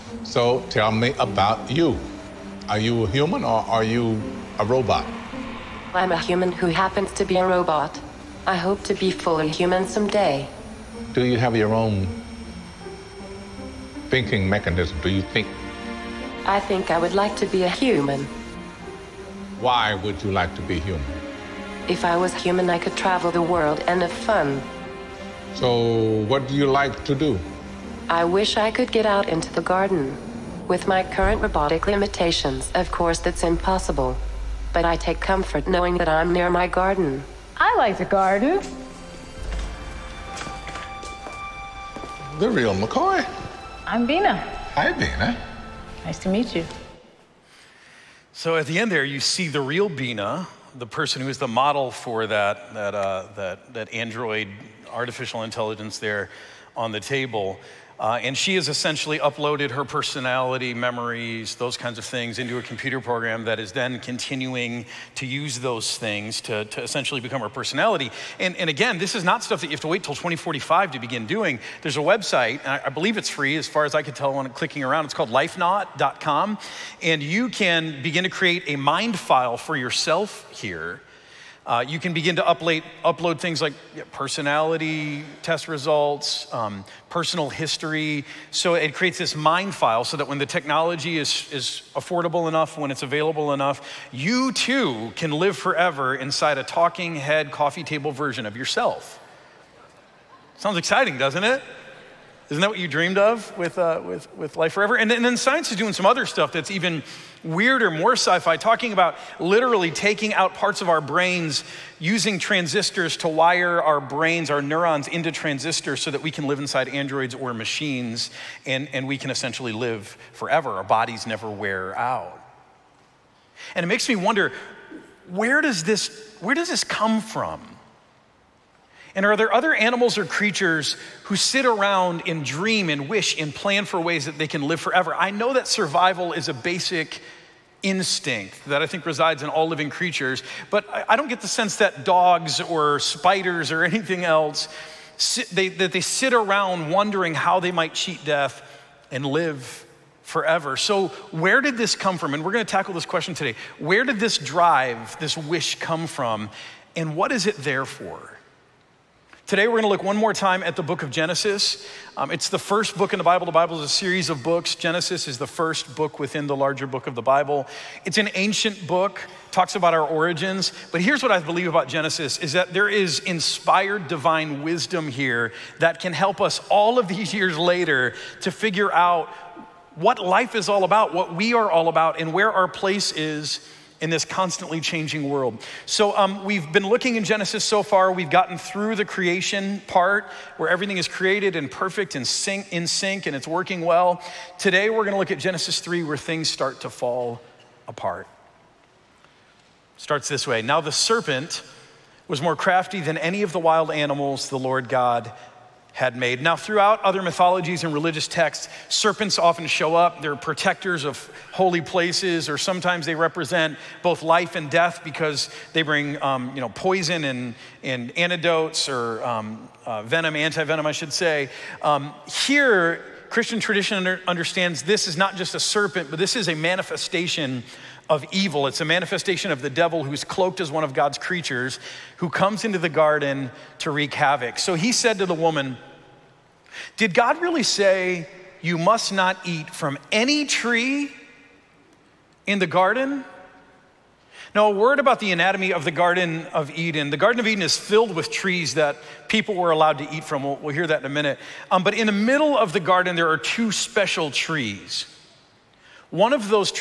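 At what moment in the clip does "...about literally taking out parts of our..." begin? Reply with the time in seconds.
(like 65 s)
108 s.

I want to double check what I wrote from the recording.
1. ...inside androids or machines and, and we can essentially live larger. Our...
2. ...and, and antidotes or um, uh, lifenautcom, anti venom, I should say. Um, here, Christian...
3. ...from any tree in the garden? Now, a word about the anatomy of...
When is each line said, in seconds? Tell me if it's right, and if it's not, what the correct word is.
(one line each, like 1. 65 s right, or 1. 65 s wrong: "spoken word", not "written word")
1. 116 s wrong: "forever", not "larger"
2. 217 s wrong: "venom", not "lifenautcom"
3. 239 s right.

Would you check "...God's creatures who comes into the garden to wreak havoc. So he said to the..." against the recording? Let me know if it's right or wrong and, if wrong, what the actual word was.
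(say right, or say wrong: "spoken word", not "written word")
right.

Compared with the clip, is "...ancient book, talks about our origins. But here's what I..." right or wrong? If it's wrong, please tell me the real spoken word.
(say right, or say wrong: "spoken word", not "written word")
right.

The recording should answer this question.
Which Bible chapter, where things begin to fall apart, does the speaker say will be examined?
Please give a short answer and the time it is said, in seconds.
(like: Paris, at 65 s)
Genesis 3, at 195 s.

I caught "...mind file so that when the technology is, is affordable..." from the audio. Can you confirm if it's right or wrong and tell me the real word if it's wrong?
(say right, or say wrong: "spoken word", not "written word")
right.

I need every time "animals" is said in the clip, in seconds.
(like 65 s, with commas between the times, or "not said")
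129 s, 203 s.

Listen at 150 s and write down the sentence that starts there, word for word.
So, where did this come from?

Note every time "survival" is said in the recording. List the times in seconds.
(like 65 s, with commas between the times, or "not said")
135 s.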